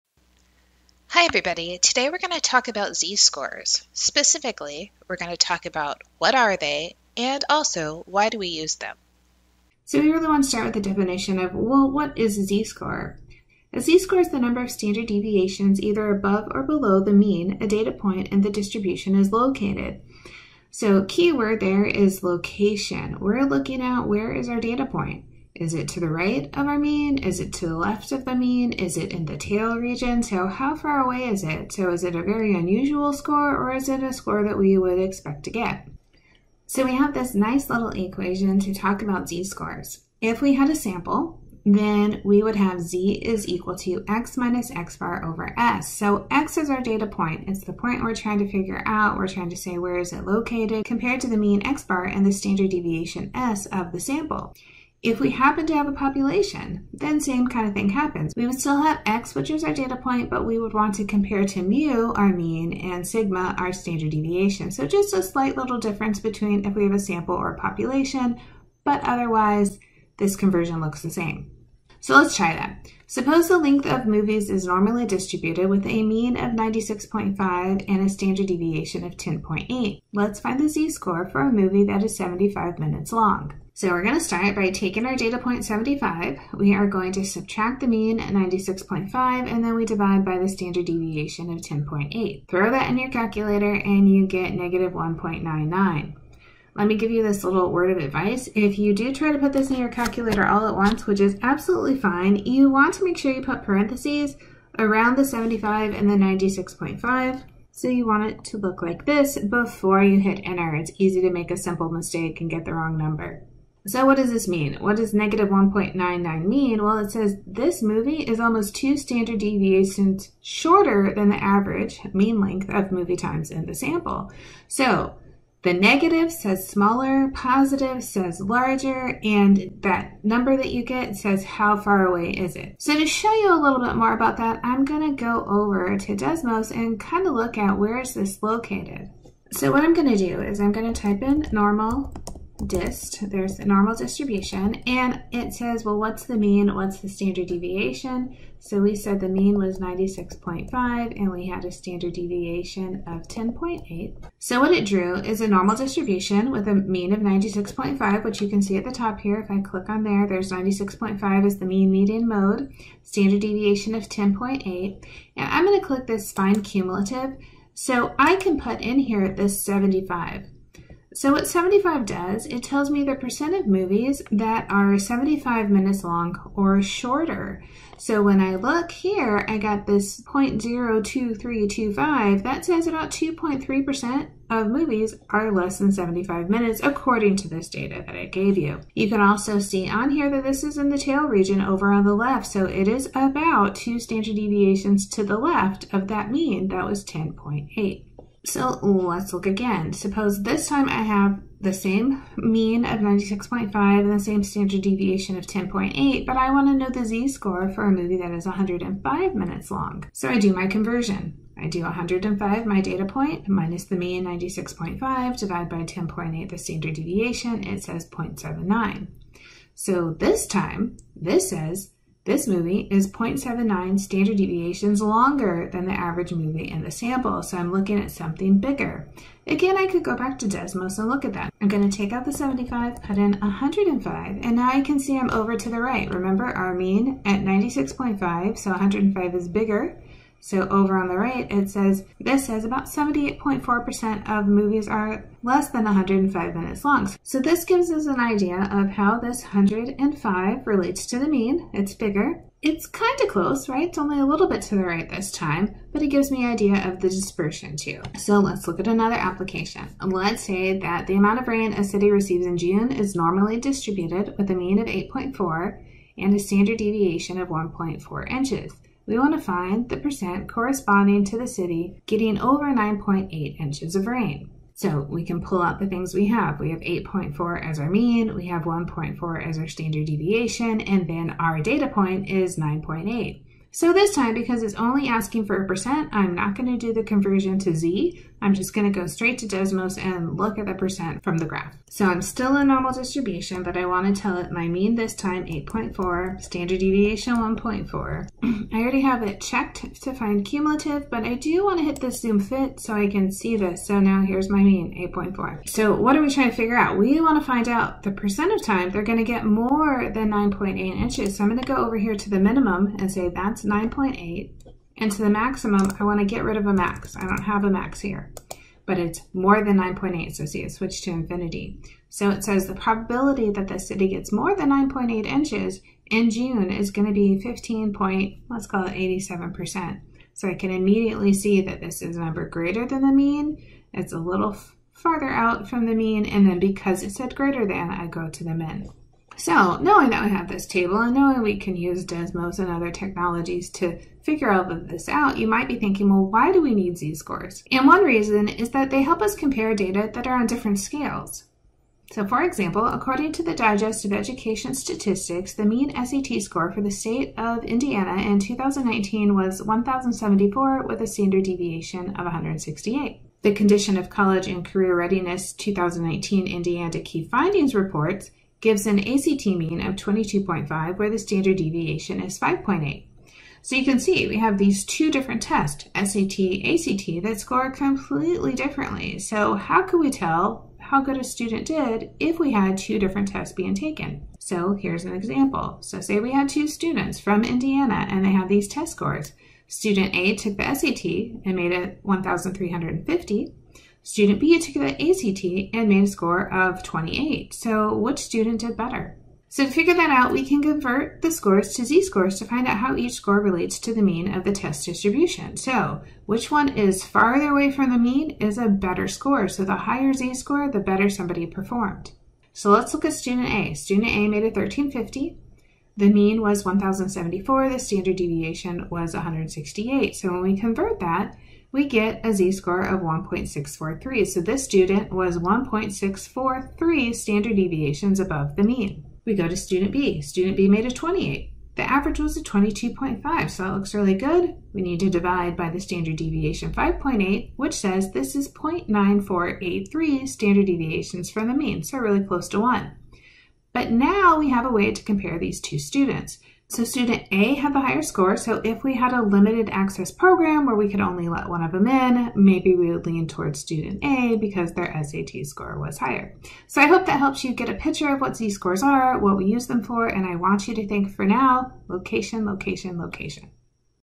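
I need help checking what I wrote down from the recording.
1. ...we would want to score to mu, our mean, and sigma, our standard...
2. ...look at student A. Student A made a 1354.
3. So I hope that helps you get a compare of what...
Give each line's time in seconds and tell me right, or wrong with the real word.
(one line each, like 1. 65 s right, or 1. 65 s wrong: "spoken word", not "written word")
1. 60 s wrong: "compare", not "score"
2. 412 s wrong: "1350", not "1354"
3. 456 s wrong: "picture", not "compare".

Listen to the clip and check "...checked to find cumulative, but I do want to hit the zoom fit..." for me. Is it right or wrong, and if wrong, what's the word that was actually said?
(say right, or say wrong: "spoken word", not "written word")
right.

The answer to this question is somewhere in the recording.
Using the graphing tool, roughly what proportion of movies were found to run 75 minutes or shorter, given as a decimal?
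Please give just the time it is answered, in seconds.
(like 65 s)
180 s.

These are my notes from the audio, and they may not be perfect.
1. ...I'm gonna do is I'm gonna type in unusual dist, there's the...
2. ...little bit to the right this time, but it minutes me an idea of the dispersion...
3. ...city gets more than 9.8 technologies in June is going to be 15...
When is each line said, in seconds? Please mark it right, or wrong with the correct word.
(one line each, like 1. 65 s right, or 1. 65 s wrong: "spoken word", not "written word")
1. 139 s wrong: "normal", not "unusual"
2. 254 s wrong: "gives", not "minutes"
3. 323 s wrong: "inches", not "technologies".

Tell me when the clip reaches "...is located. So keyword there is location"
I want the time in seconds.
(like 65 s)
19 s.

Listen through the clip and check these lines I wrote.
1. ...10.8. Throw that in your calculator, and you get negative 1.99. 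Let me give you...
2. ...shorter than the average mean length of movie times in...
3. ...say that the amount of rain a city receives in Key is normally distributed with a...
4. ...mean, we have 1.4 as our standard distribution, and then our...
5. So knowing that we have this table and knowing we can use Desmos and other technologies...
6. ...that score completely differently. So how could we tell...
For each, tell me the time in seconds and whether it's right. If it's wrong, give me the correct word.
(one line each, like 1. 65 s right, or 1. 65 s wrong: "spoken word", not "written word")
1. 91 s right
2. 120 s right
3. 260 s wrong: "June", not "Key"
4. 277 s wrong: "deviation", not "distribution"
5. 339 s right
6. 377 s right.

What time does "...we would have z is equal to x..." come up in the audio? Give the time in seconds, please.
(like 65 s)
42 s.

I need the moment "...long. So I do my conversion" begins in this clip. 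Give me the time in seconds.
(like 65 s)
209 s.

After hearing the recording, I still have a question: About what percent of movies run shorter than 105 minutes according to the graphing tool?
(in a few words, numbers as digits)
78.4%.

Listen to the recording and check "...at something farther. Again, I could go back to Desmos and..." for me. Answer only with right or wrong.
wrong.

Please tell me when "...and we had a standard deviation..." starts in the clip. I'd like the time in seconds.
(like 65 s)
151 s.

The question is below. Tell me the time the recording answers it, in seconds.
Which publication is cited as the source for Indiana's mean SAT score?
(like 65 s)
353 s.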